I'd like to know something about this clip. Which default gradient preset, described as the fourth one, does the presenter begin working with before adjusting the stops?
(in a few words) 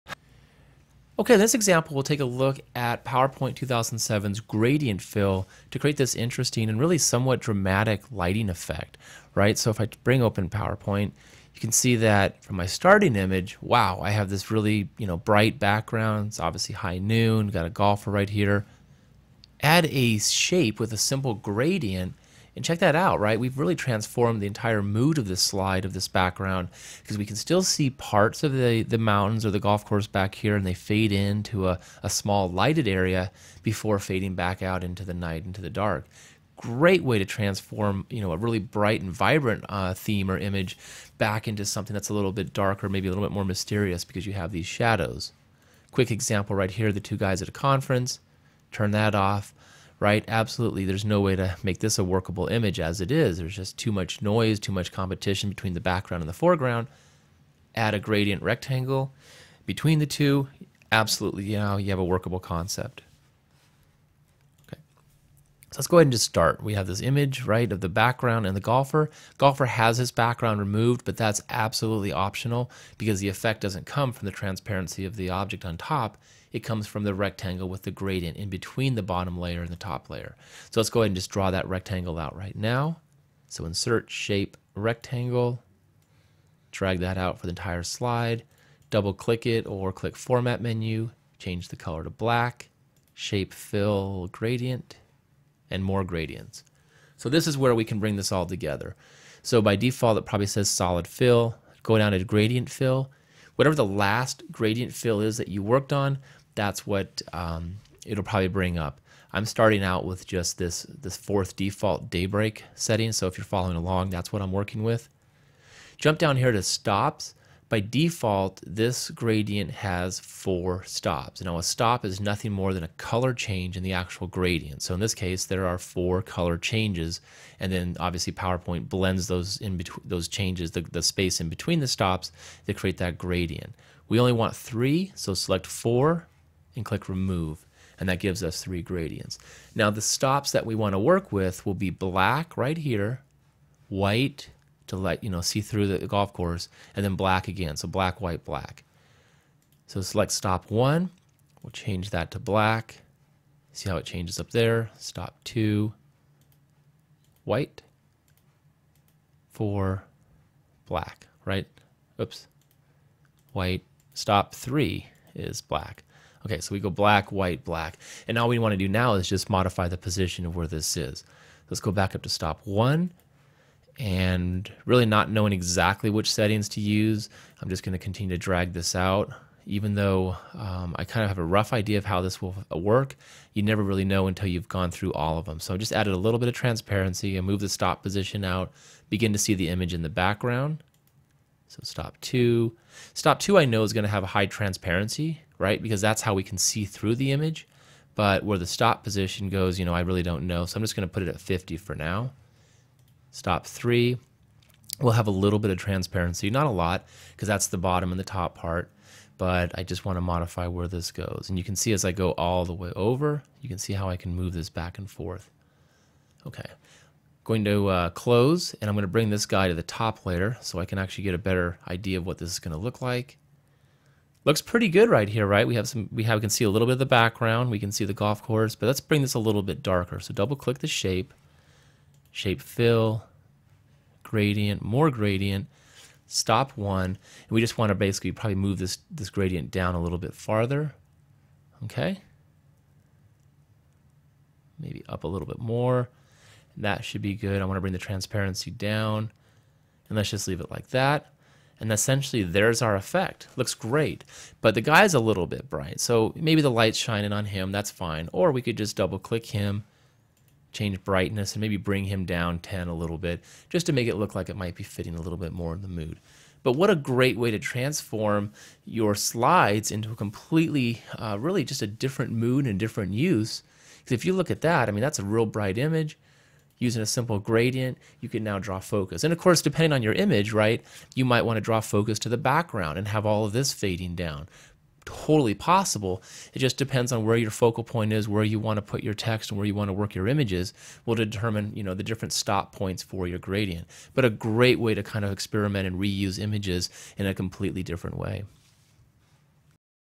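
daybreak.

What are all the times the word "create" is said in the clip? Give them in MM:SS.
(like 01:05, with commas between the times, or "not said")
00:05, 02:12.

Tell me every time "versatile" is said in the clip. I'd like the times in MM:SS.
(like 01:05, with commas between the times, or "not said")
not said.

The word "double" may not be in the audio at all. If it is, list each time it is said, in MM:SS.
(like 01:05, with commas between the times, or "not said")
01:28, 03:50, 04:18.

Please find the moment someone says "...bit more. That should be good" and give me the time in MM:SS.
04:05.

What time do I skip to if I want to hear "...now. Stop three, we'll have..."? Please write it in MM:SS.
03:21.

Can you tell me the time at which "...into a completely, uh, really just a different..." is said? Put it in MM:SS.
04:29.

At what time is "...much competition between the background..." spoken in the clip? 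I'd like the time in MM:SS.
00:54.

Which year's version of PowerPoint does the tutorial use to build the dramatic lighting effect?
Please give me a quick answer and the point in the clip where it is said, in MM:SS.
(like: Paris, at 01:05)
2007, at 00:03.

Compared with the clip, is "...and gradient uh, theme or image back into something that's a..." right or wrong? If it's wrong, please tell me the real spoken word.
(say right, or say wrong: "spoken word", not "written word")
wrong: "vibrant", not "gradient".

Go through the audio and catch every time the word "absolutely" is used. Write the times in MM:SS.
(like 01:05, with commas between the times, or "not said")
00:50, 01:00, 01:11.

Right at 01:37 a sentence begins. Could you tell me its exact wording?
So this is where we can bring this all together.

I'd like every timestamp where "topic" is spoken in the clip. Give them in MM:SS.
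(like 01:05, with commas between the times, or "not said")
not said.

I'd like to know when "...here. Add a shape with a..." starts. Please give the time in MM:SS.
00:18.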